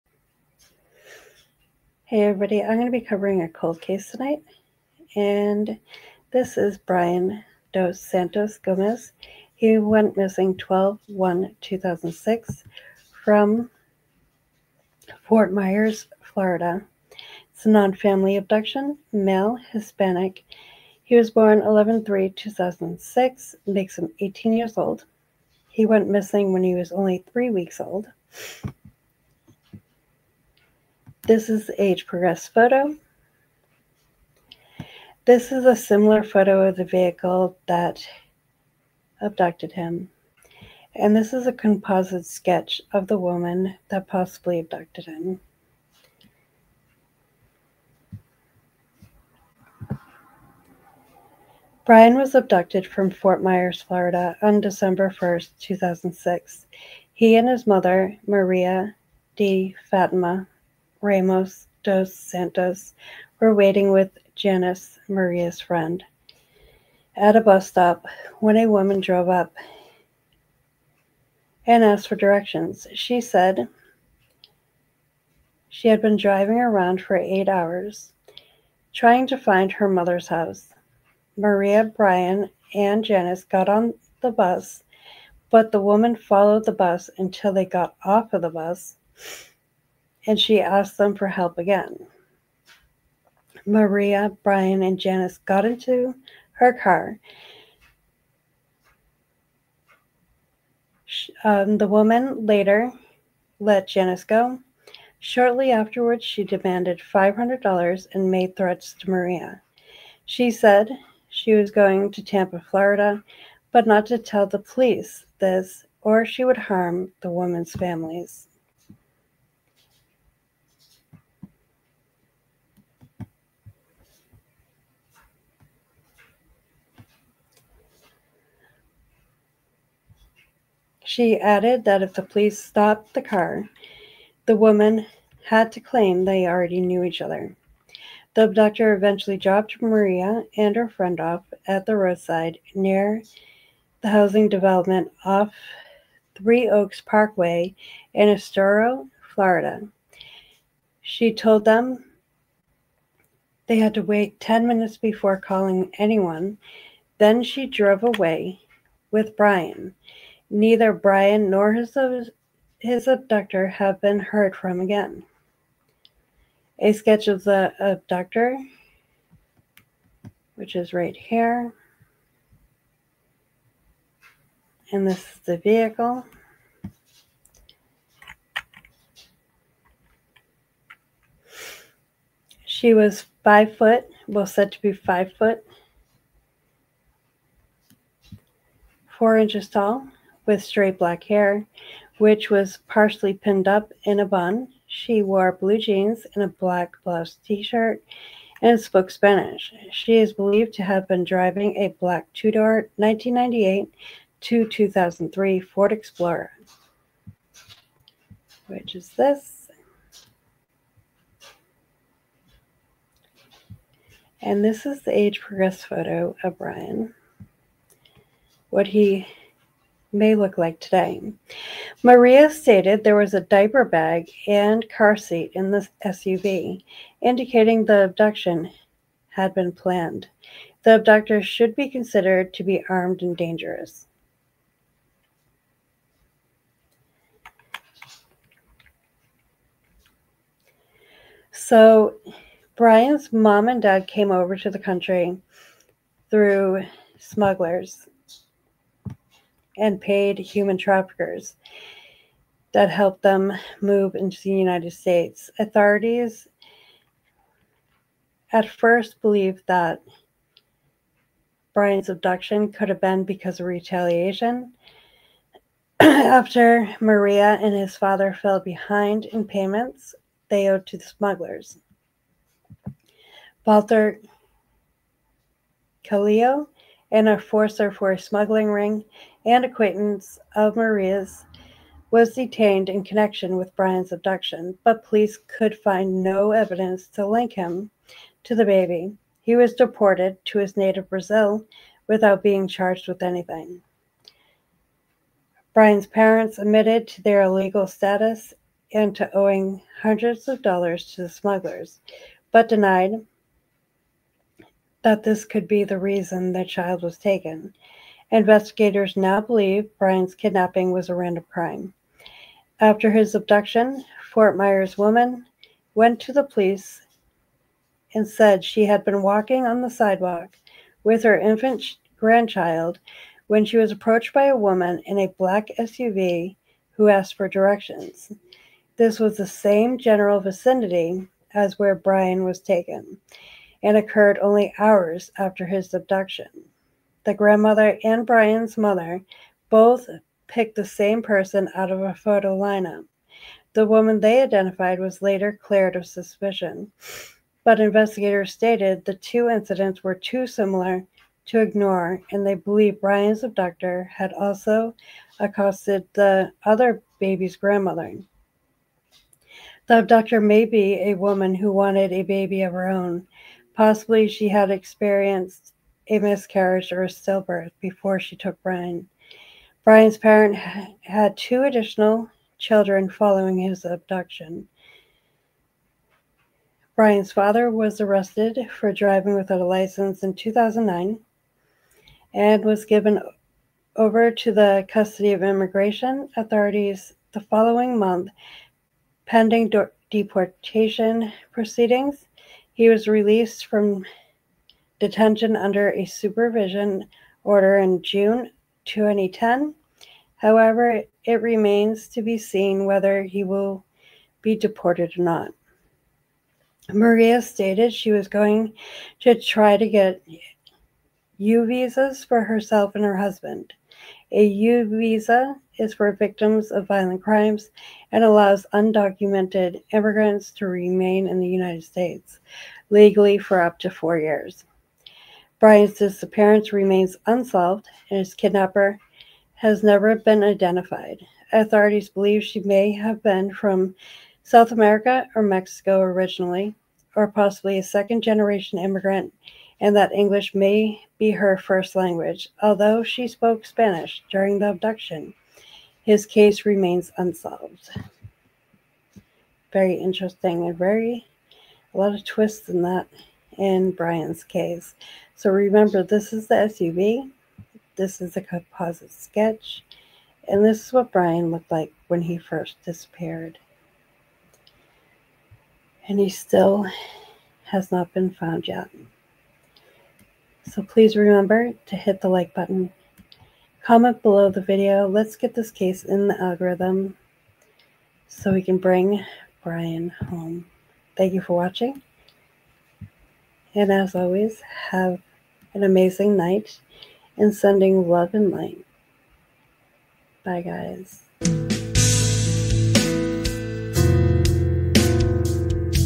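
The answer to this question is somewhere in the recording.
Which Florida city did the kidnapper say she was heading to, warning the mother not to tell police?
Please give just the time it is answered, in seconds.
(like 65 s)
112 s.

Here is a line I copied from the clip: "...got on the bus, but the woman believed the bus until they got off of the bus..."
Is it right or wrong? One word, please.
wrong.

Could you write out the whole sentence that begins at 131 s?
She added that if the police stopped the car, the woman had to claim they already knew each other.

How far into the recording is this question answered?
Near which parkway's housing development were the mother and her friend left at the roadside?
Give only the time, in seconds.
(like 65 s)
146 s.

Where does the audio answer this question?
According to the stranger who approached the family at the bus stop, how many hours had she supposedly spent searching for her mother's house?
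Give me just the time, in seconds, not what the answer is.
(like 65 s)
77 s.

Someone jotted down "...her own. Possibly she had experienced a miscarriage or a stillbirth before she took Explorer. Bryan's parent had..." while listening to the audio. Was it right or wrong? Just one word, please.
wrong.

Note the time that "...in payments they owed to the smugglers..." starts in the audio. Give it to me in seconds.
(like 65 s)
269 s.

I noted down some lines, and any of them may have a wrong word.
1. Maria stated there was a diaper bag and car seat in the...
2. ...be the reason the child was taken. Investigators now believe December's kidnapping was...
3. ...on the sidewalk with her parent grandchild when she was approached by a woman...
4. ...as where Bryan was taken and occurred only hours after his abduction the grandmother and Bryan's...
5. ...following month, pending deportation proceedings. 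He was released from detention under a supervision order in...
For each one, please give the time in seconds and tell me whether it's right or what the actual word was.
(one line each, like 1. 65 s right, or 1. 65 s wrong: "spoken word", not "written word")
1. 222 s right
2. 305 s wrong: "Bryan", not "December"
3. 319 s wrong: "infant", not "parent"
4. 331 s right
5. 387 s right.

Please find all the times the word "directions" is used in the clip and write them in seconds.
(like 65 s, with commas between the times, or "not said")
72 s, 327 s.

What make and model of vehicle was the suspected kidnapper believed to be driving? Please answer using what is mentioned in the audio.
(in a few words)
Ford Explorer.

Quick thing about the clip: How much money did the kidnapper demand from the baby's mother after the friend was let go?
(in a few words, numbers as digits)
$500.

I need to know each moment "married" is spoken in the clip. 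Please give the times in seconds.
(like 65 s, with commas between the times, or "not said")
not said.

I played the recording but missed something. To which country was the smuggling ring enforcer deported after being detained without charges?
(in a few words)
Brazil.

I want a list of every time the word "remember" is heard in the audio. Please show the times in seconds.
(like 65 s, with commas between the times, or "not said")
455 s, 471 s.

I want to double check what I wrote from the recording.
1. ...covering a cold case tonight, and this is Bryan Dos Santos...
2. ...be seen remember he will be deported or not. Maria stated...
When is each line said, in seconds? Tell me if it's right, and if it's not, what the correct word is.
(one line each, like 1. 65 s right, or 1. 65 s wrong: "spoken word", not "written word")
1. 2 s right
2. 402 s wrong: "whether", not "remember".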